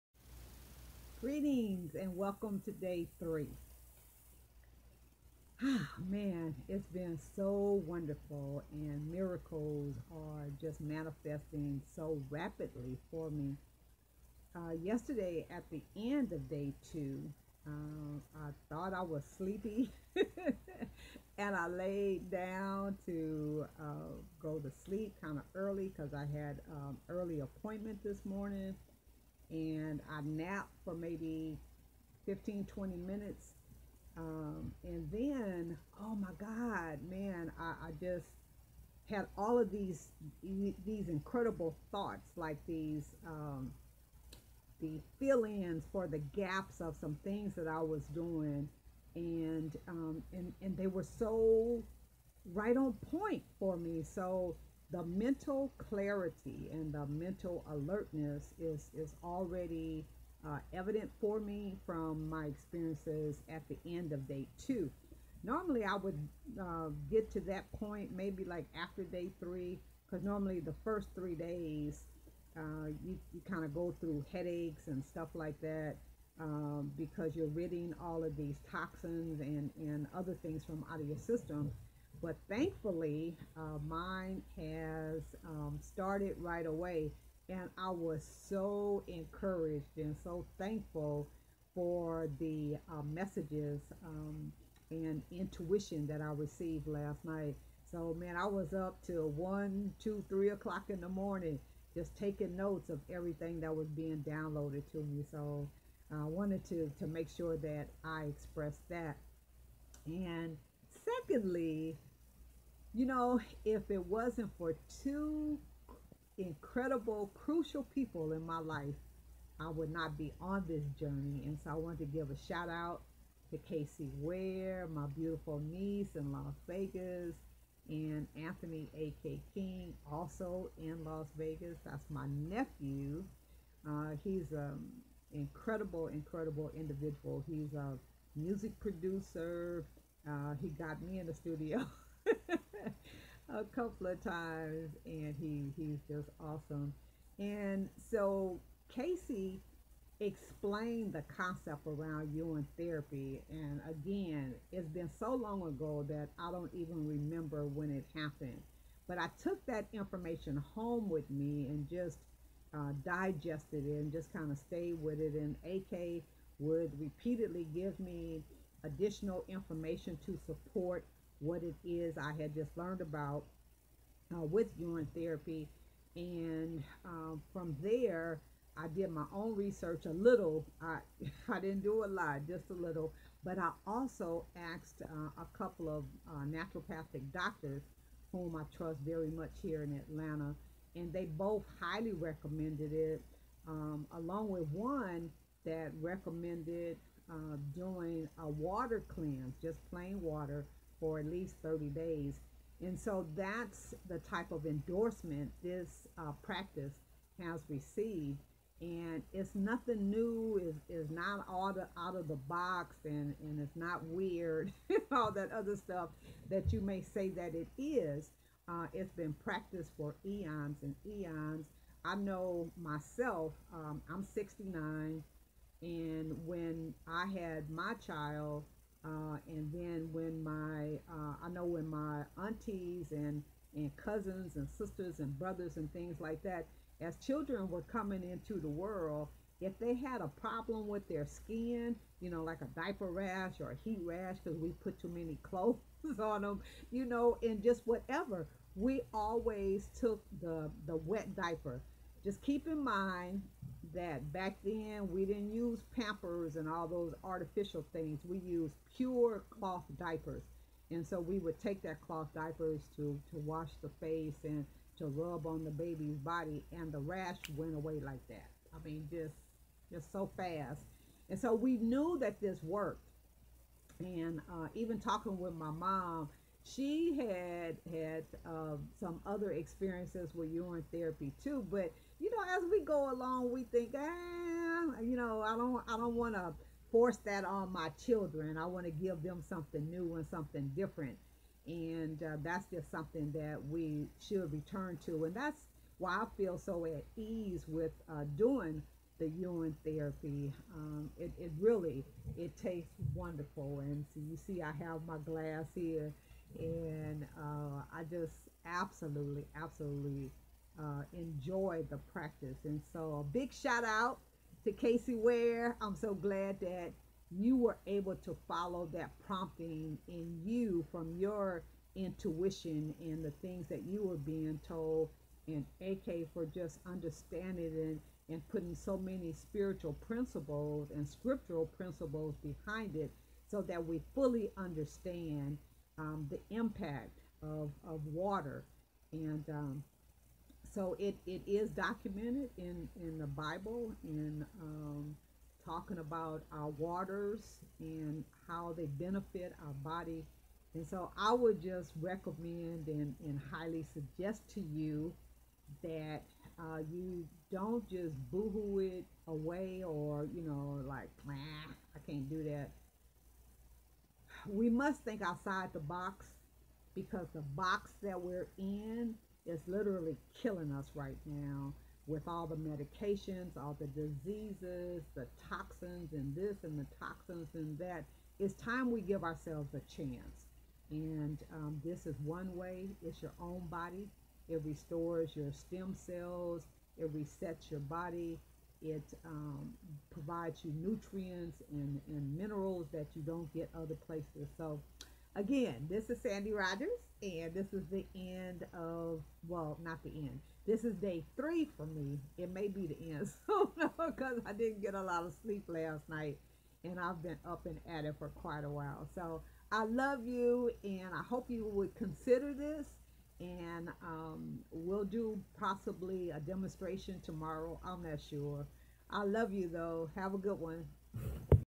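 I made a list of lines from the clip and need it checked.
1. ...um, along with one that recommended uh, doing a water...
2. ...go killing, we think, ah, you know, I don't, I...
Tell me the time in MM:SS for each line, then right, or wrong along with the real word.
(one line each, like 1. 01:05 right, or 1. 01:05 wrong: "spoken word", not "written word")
1. 03:13 right
2. 04:42 wrong: "along", not "killing".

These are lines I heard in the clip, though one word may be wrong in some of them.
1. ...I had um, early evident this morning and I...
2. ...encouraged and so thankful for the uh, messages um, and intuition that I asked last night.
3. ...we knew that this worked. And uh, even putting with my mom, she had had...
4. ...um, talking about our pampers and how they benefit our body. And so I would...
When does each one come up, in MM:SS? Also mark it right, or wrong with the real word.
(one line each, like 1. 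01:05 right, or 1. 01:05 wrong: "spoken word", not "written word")
1. 00:26 wrong: "appointment", not "evident"
2. 01:29 wrong: "received", not "asked"
3. 04:31 wrong: "talking", not "putting"
4. 05:44 wrong: "waters", not "pampers".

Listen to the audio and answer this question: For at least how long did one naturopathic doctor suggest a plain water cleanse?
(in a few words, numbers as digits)
30 days.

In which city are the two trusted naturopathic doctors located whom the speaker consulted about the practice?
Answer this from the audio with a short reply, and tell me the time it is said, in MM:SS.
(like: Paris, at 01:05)
Atlanta, at 03:09.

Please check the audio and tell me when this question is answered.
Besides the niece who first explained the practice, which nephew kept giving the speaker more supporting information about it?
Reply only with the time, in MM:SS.
02:08.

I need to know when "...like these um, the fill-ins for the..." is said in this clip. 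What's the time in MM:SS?
00:42.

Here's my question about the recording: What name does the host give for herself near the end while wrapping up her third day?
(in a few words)
Sandy Rodgers.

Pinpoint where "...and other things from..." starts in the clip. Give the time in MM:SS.
01:19.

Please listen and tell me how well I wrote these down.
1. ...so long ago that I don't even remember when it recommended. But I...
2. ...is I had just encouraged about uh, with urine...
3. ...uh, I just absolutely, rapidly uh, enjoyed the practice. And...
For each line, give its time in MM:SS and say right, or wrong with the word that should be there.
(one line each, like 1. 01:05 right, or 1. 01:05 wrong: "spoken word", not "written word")
1. 02:35 wrong: "happened", not "recommended"
2. 02:51 wrong: "learned", not "encouraged"
3. 05:07 wrong: "absolutely", not "rapidly".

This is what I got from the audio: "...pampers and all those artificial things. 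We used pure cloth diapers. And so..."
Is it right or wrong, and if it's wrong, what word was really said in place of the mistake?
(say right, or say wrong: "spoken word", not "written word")
right.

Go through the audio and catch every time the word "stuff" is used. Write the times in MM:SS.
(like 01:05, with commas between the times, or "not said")
01:15, 03:35.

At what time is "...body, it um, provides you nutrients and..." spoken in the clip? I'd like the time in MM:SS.
06:27.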